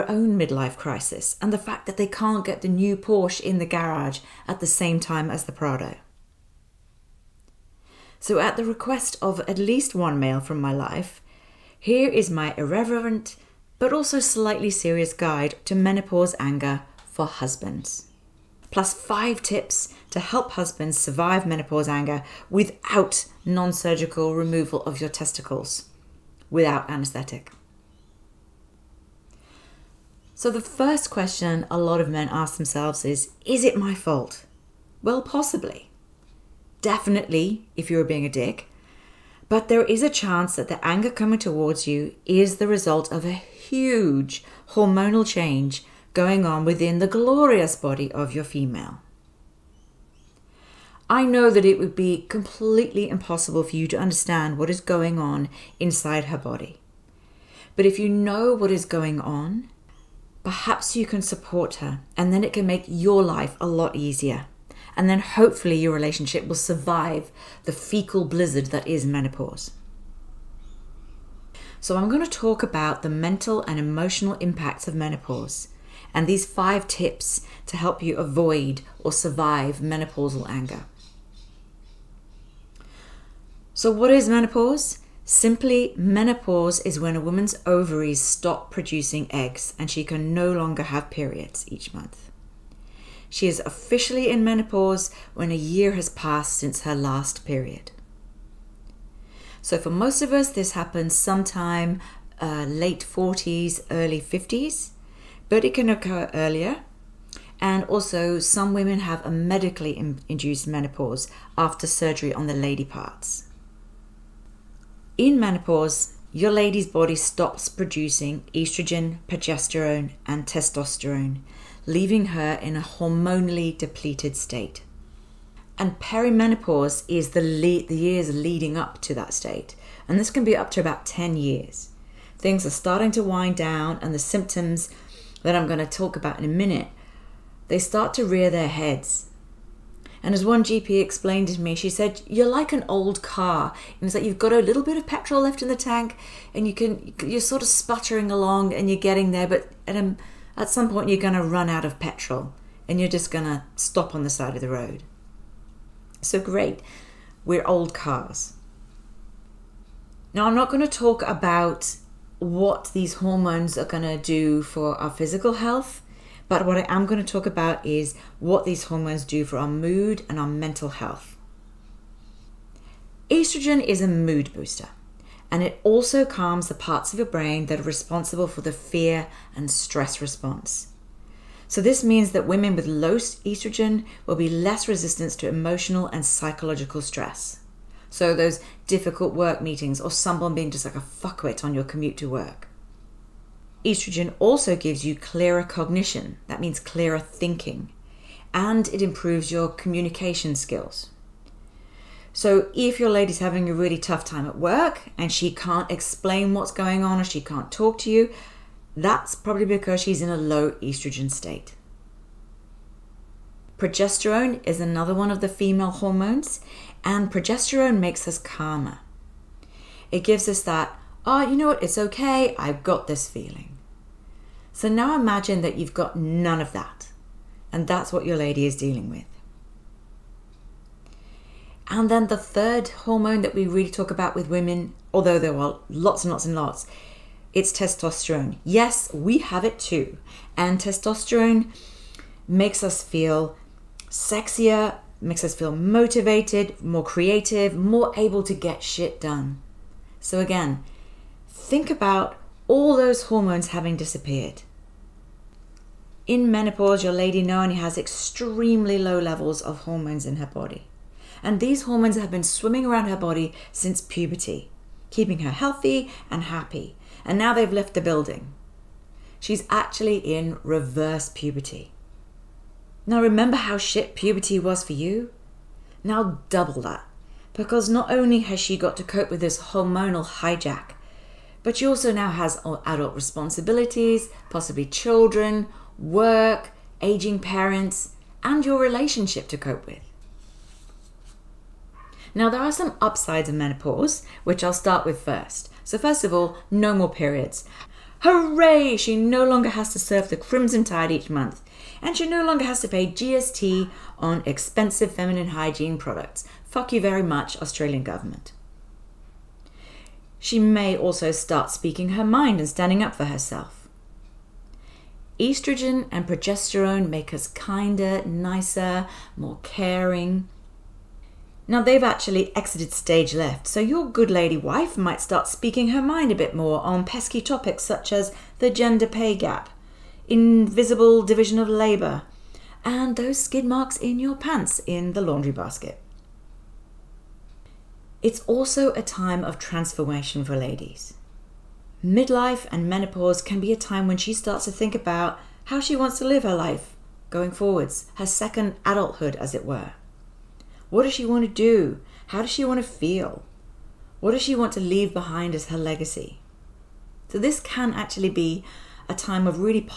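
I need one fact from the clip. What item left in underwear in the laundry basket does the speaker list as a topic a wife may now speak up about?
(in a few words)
skid marks.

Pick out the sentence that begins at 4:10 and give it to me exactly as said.
So, again, think about all those hormones having disappeared.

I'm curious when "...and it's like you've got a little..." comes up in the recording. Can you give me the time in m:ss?
2:23.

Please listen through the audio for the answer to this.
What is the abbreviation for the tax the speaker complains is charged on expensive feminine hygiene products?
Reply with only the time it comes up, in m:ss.
5:03.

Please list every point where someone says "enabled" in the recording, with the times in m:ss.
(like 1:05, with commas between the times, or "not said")
not said.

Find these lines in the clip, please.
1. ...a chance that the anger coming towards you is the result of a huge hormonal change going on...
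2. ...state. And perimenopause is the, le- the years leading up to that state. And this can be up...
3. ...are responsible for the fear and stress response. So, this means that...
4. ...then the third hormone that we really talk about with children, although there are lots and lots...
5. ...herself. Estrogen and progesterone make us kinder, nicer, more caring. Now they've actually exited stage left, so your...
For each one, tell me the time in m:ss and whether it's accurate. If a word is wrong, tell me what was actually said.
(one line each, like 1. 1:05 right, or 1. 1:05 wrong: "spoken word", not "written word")
1. 0:40 right
2. 2:04 right
3. 2:57 right
4. 3:52 wrong: "women", not "children"
5. 5:13 right.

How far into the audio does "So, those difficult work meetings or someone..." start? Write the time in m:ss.
3:08.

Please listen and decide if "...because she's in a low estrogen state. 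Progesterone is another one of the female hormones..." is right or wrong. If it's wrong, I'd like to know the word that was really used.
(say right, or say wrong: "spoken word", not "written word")
right.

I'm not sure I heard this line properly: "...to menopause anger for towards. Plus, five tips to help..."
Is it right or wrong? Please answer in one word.
wrong.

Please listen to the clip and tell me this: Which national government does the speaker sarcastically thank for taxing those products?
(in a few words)
Australian government.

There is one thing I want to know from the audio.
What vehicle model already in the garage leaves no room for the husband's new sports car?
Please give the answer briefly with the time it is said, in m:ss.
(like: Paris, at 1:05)
Prado, at 0:05.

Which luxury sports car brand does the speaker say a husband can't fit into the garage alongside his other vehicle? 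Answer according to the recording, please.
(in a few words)
Porsche.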